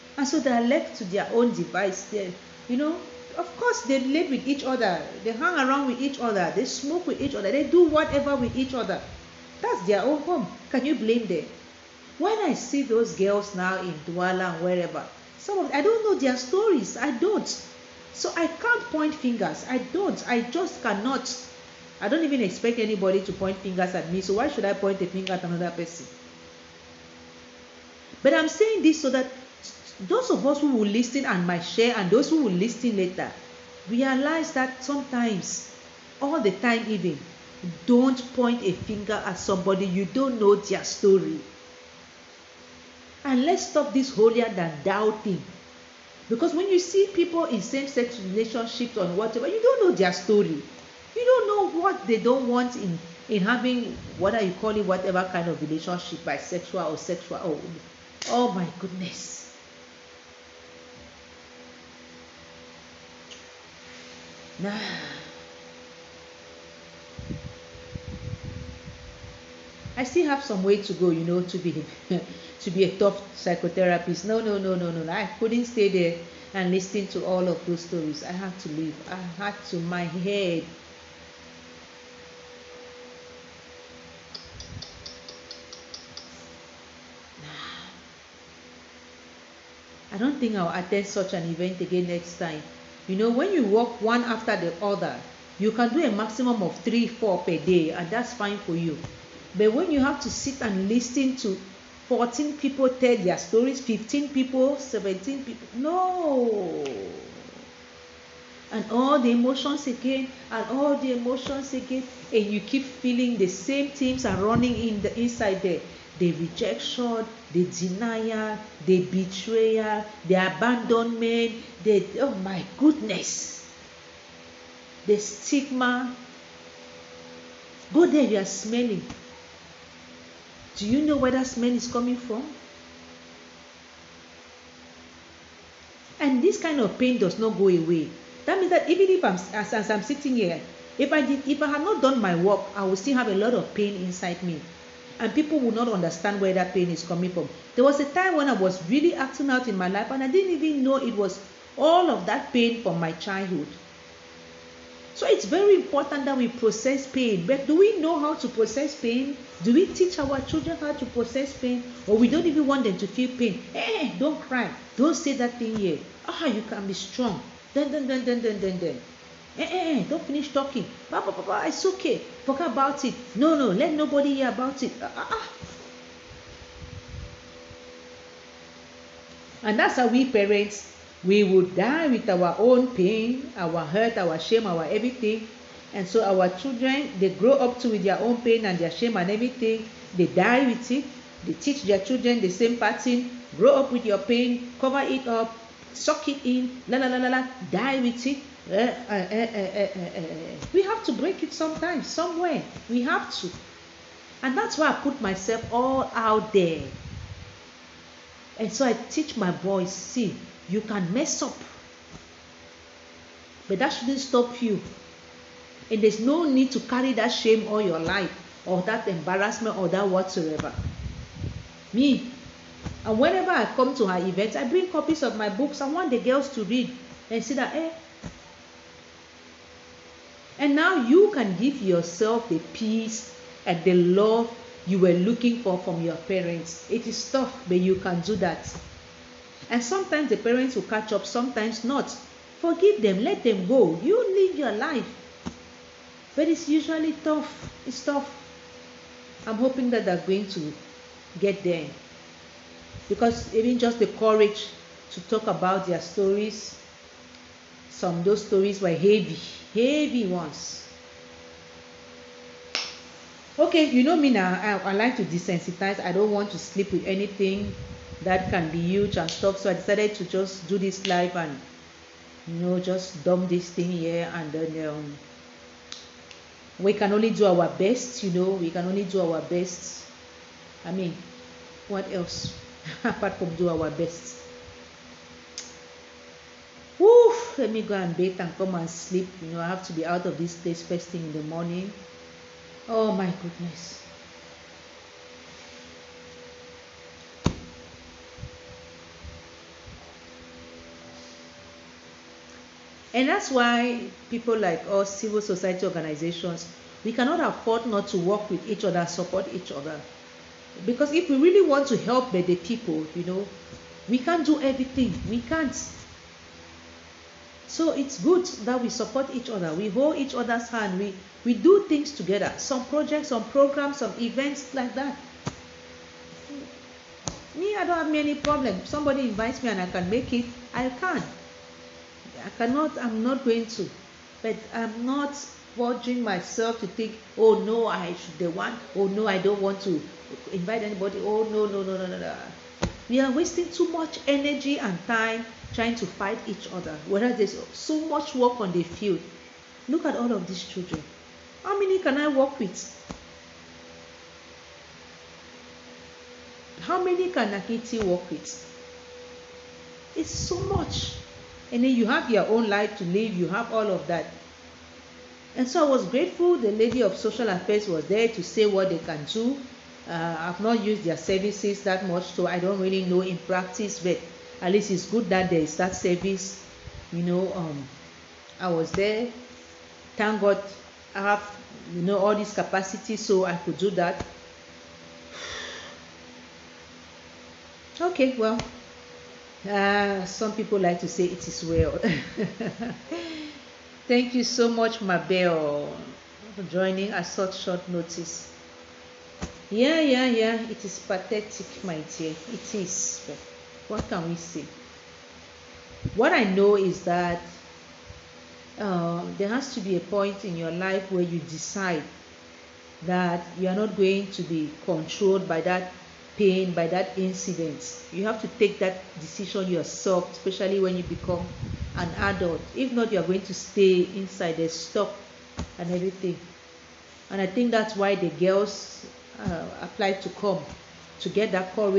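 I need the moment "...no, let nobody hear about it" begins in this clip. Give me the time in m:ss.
2:53.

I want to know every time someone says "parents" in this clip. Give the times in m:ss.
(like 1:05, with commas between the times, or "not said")
3:00, 3:56, 4:00.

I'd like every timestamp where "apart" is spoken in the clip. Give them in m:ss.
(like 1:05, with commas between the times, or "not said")
4:43.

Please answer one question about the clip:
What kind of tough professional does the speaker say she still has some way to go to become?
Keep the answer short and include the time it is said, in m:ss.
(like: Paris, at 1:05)
psychotherapist, at 1:13.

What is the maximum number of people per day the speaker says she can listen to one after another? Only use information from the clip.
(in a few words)
4.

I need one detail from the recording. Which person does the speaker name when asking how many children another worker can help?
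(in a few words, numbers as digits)
Nakiti.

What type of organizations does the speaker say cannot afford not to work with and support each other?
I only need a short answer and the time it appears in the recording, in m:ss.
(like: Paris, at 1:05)
civil society organizations, at 5:05.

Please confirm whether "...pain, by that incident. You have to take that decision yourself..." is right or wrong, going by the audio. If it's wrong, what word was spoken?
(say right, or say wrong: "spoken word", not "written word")
right.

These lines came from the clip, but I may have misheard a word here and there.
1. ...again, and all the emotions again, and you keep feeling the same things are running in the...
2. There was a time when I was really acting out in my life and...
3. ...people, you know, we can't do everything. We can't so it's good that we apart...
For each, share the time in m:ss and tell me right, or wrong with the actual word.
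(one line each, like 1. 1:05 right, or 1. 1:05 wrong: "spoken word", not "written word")
1. 1:49 right
2. 2:27 right
3. 5:12 wrong: "support", not "apart".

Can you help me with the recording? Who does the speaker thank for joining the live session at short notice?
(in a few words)
Mabel.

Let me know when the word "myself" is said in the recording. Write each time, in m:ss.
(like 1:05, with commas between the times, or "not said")
3:25, 5:36.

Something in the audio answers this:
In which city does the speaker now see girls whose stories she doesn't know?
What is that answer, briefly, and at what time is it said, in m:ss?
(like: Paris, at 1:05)
Douala, at 0:14.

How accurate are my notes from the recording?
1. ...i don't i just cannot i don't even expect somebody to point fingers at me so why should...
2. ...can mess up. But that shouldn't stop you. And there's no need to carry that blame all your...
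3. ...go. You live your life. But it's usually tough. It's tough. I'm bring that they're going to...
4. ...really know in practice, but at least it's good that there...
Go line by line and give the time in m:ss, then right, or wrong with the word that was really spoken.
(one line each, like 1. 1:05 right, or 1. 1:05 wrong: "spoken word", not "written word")
1. 0:19 wrong: "anybody", not "somebody"
2. 3:30 wrong: "shame", not "blame"
3. 4:03 wrong: "hoping", not "bring"
4. 6:12 right.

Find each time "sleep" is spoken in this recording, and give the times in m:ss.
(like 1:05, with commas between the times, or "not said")
4:26, 4:48.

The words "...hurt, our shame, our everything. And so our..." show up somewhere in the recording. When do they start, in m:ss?
3:03.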